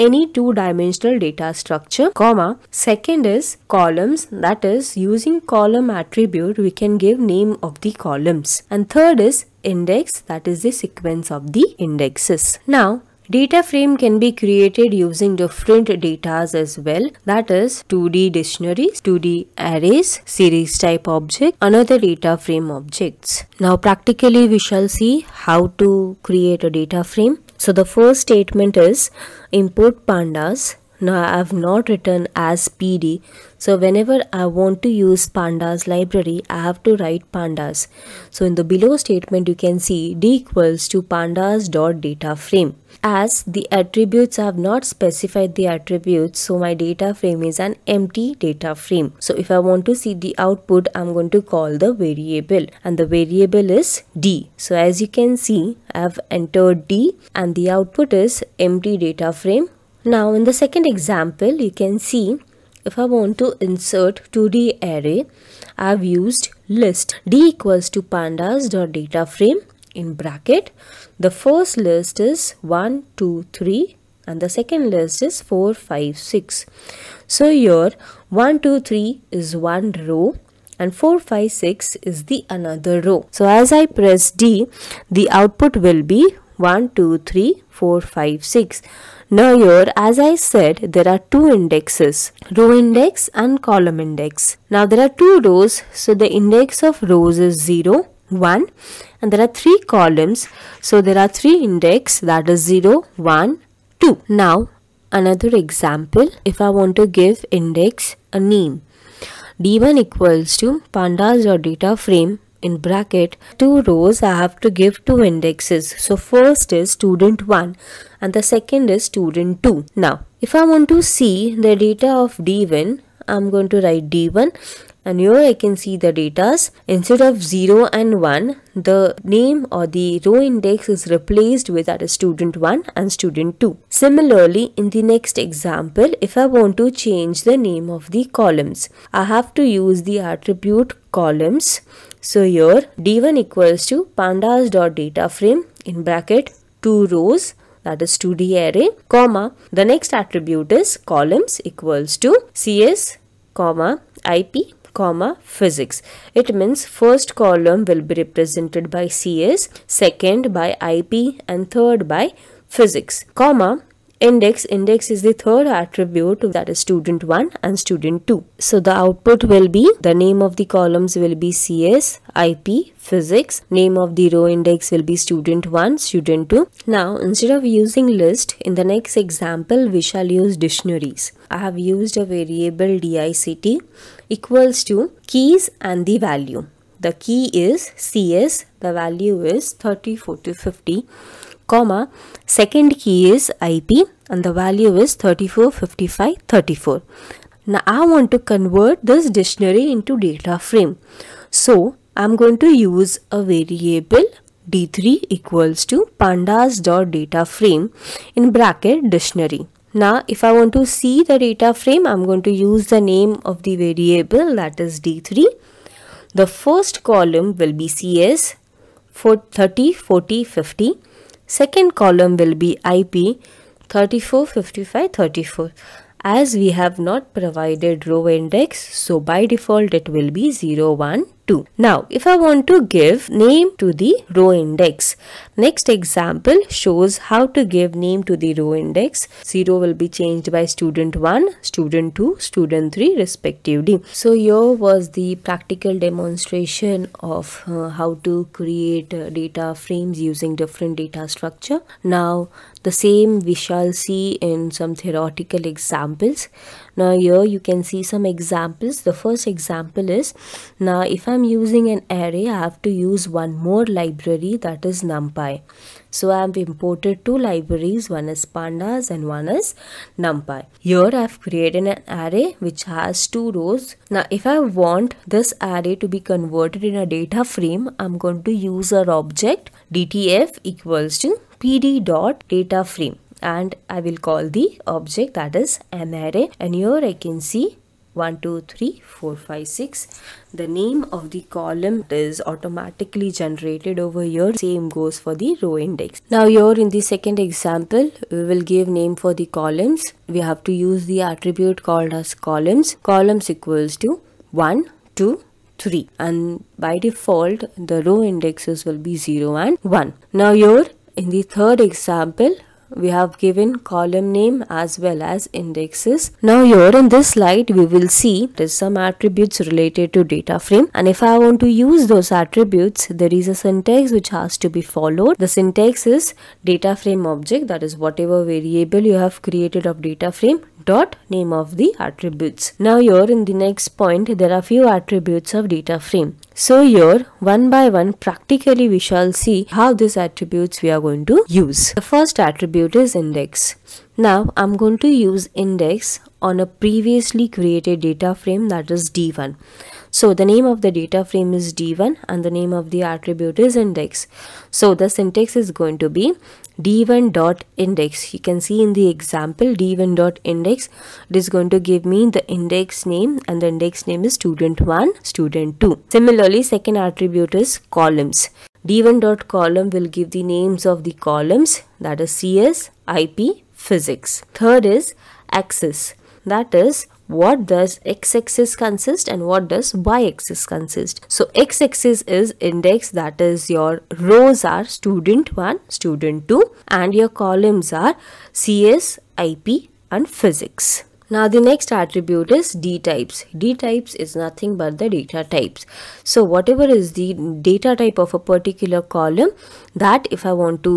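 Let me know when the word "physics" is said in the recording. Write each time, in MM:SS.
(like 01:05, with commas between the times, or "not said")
02:35, 02:42, 02:53, 06:13, 06:30.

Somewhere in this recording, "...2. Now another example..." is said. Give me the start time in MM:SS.
01:44.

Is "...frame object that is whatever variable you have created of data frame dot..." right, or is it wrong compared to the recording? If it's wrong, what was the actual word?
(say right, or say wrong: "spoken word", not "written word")
right.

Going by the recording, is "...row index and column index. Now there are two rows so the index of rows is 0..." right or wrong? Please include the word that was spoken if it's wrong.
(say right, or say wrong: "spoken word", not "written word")
right.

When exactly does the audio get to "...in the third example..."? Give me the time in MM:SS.
05:11.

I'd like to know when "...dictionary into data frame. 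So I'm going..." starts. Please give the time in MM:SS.
03:19.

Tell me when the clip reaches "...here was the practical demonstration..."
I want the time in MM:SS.
04:04.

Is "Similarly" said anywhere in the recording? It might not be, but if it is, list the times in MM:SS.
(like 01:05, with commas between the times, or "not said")
02:13, 06:06.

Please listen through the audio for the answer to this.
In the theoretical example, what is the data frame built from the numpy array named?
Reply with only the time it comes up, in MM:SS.
04:39.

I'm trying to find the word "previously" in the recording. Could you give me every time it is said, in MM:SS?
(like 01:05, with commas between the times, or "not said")
05:46.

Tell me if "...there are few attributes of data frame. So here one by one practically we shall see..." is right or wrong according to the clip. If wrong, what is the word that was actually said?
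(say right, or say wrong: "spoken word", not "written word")
right.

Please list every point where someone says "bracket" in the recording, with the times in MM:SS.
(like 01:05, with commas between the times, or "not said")
01:10, 01:52, 02:26, 03:28.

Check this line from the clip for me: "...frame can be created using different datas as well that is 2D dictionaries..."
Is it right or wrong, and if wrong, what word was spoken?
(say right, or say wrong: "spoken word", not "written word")
right.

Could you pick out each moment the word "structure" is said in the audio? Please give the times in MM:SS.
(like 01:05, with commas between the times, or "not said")
00:01, 04:11.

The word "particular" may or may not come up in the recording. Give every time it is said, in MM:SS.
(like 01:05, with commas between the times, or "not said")
06:38.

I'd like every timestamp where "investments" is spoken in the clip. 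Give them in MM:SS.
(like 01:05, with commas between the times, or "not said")
not said.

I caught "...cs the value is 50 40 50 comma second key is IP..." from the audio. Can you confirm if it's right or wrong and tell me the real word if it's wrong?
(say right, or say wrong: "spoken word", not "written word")
wrong: "30", not "50".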